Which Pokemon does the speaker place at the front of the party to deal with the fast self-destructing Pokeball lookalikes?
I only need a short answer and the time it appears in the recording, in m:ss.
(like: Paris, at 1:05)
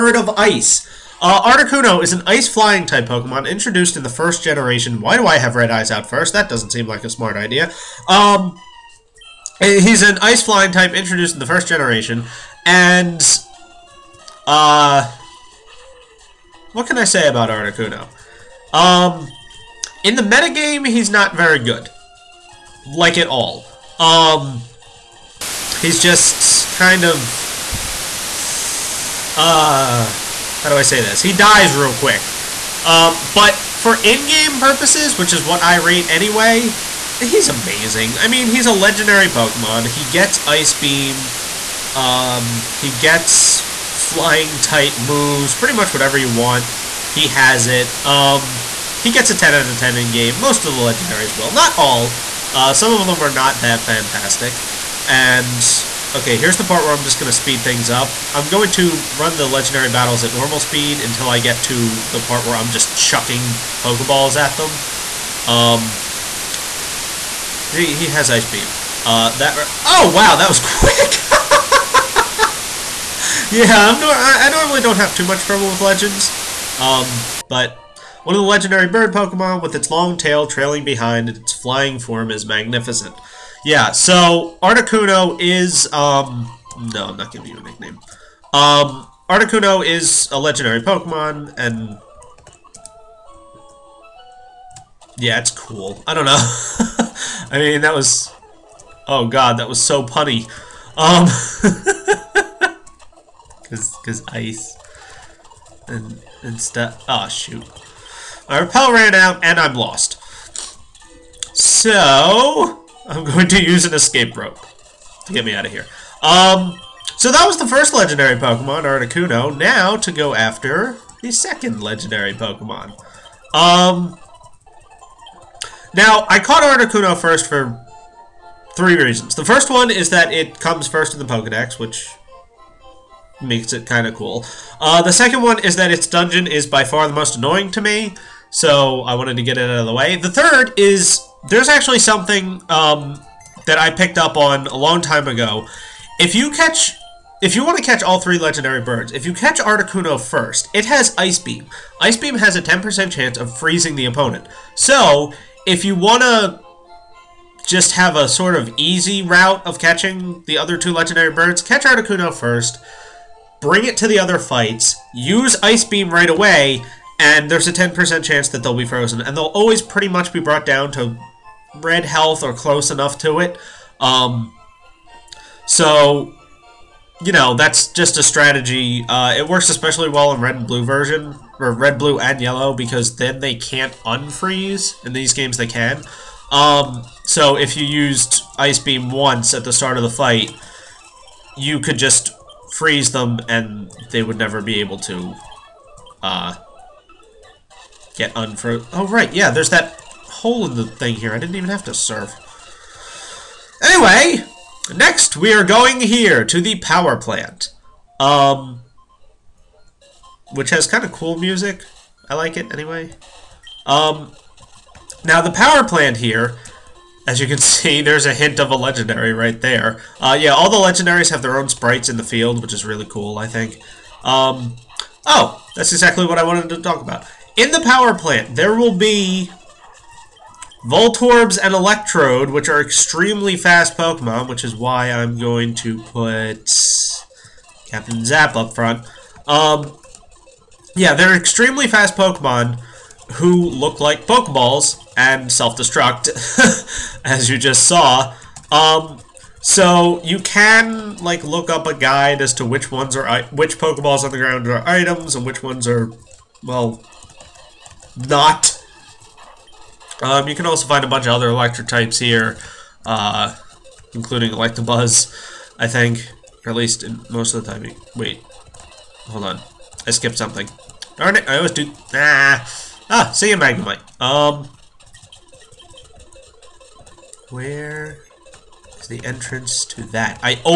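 Captain Zap, at 3:57.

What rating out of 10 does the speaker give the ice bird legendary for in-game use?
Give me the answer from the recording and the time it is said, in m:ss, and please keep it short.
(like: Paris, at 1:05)
10 out of 10, at 0:49.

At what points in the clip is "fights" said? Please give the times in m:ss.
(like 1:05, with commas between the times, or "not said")
2:44, 3:10.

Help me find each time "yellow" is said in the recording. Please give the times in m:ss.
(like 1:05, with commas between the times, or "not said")
3:02.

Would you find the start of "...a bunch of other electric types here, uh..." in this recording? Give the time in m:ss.
4:21.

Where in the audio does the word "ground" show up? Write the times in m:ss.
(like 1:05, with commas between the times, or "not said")
4:14.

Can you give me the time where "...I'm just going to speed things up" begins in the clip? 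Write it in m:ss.
0:56.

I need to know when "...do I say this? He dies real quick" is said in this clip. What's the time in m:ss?
0:30.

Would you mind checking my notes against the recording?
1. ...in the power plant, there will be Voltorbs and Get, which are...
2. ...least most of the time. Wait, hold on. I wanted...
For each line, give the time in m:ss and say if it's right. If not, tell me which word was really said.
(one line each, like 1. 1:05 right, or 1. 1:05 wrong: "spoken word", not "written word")
1. 3:47 wrong: "Electrode", not "Get"
2. 4:26 wrong: "skipped", not "wanted".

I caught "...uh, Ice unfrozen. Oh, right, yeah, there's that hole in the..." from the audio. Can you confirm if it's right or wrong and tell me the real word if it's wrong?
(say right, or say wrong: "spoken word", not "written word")
wrong: "Get", not "Ice".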